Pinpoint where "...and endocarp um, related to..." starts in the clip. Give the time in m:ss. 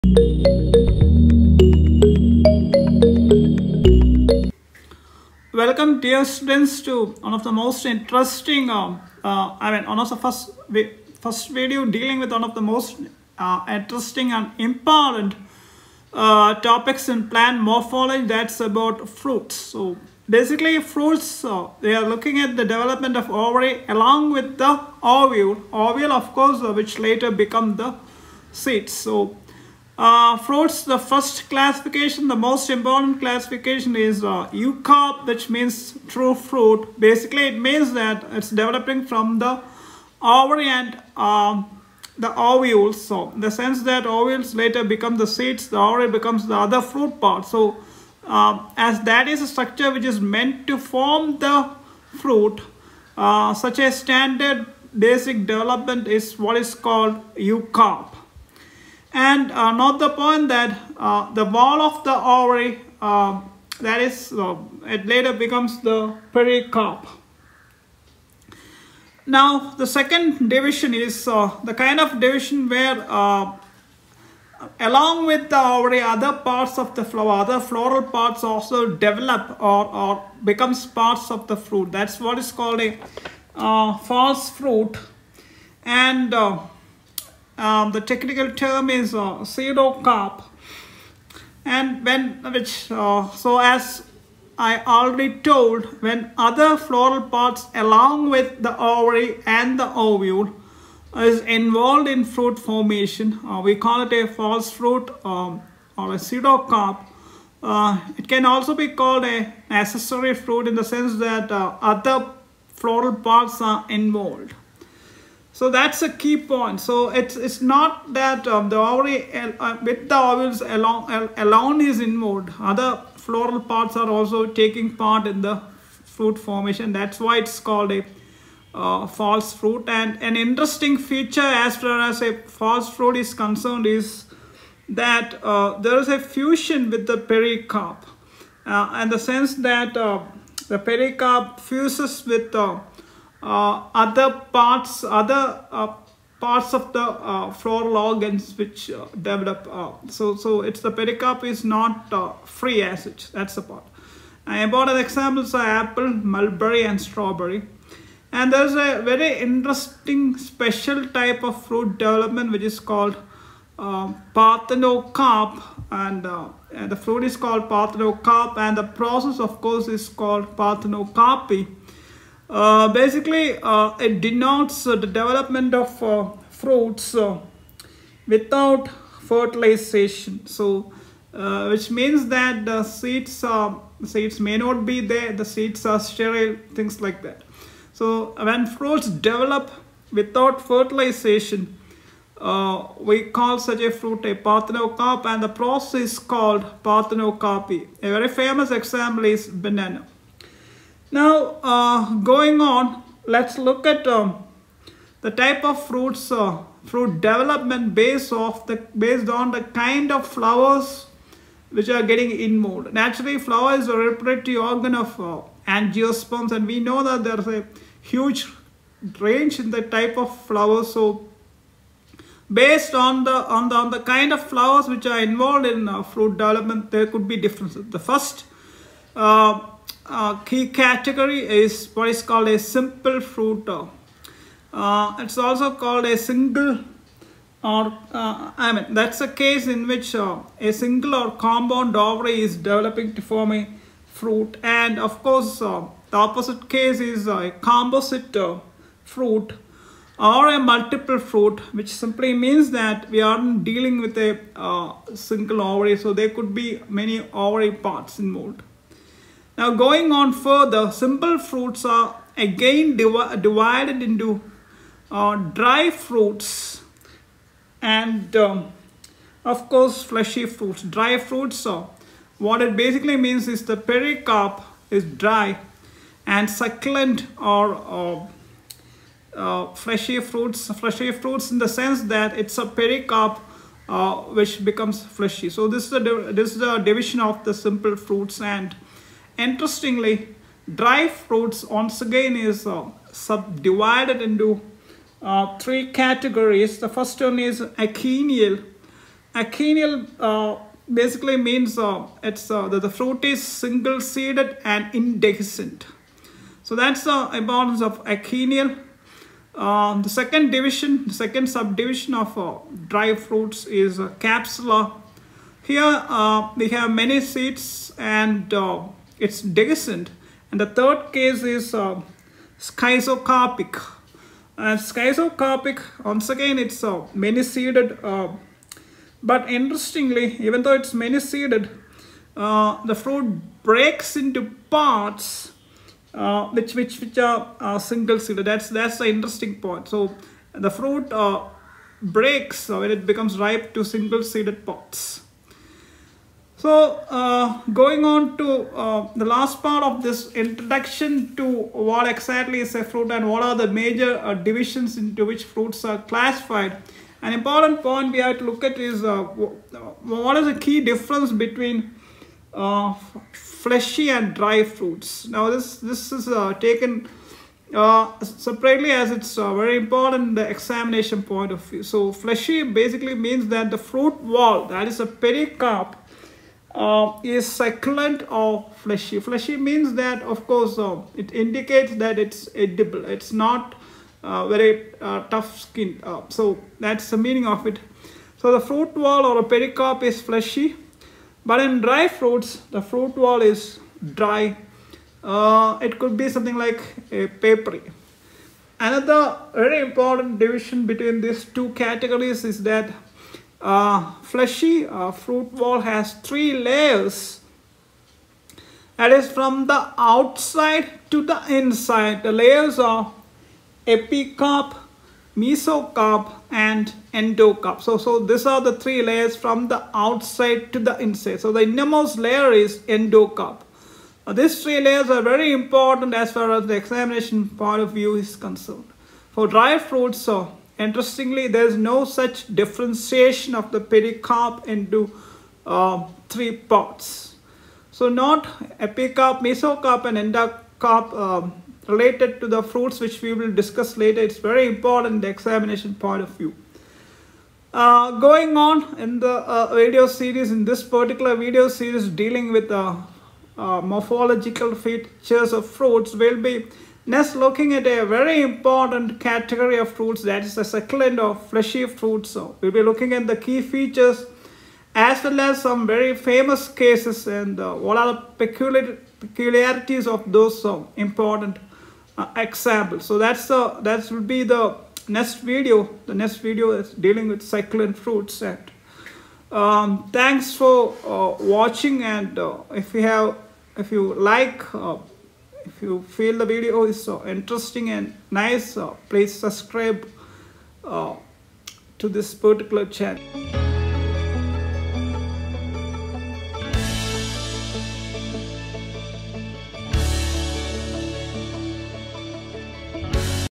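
7:20.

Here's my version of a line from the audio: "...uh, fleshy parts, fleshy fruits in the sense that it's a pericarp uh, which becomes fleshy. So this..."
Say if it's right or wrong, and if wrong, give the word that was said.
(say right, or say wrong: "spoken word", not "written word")
wrong: "fruits", not "parts".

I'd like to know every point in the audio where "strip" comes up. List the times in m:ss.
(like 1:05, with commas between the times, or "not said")
not said.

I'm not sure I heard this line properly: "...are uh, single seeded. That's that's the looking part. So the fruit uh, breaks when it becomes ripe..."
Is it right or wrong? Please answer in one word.
wrong.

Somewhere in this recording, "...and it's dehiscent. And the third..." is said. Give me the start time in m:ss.
5:17.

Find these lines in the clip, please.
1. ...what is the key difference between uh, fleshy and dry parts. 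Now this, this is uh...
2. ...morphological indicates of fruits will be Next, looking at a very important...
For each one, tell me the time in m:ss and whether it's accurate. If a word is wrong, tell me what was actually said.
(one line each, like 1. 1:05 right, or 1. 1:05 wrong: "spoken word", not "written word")
1. 6:00 wrong: "fruits", not "parts"
2. 7:33 wrong: "features", not "indicates".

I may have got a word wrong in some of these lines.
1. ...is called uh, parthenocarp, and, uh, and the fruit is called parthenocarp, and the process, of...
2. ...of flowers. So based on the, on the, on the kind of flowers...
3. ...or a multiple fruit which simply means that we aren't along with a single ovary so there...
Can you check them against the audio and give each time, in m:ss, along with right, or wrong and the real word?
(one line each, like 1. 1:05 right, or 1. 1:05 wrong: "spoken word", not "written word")
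1. 2:42 right
2. 3:40 right
3. 4:10 wrong: "dealing", not "along".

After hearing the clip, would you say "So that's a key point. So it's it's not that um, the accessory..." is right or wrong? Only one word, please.
wrong.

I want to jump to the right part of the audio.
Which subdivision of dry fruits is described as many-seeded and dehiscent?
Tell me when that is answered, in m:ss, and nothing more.
5:13.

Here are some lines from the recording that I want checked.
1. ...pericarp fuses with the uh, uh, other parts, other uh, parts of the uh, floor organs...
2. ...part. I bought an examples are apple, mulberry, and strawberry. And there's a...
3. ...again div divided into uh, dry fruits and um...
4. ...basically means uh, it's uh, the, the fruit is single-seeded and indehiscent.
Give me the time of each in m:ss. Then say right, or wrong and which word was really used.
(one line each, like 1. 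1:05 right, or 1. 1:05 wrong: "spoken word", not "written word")
1. 2:20 right
2. 2:33 right
3. 4:22 right
4. 5:00 right.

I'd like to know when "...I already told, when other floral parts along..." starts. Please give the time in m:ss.
1:34.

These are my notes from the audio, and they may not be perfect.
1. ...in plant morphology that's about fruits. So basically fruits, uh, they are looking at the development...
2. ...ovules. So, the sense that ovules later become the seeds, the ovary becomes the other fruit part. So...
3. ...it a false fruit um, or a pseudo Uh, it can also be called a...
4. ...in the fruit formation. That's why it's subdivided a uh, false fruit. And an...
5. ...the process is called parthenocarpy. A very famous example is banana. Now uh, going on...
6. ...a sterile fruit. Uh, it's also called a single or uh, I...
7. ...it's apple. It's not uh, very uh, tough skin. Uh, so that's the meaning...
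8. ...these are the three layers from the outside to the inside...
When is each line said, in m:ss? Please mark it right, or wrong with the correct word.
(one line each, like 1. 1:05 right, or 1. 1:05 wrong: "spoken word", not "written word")
1. 0:17 right
2. 0:42 right
3. 1:44 right
4. 2:05 wrong: "called", not "subdivided"
5. 3:15 right
6. 3:52 wrong: "simple", not "sterile"
7. 6:22 wrong: "edible", not "apple"
8. 6:58 right.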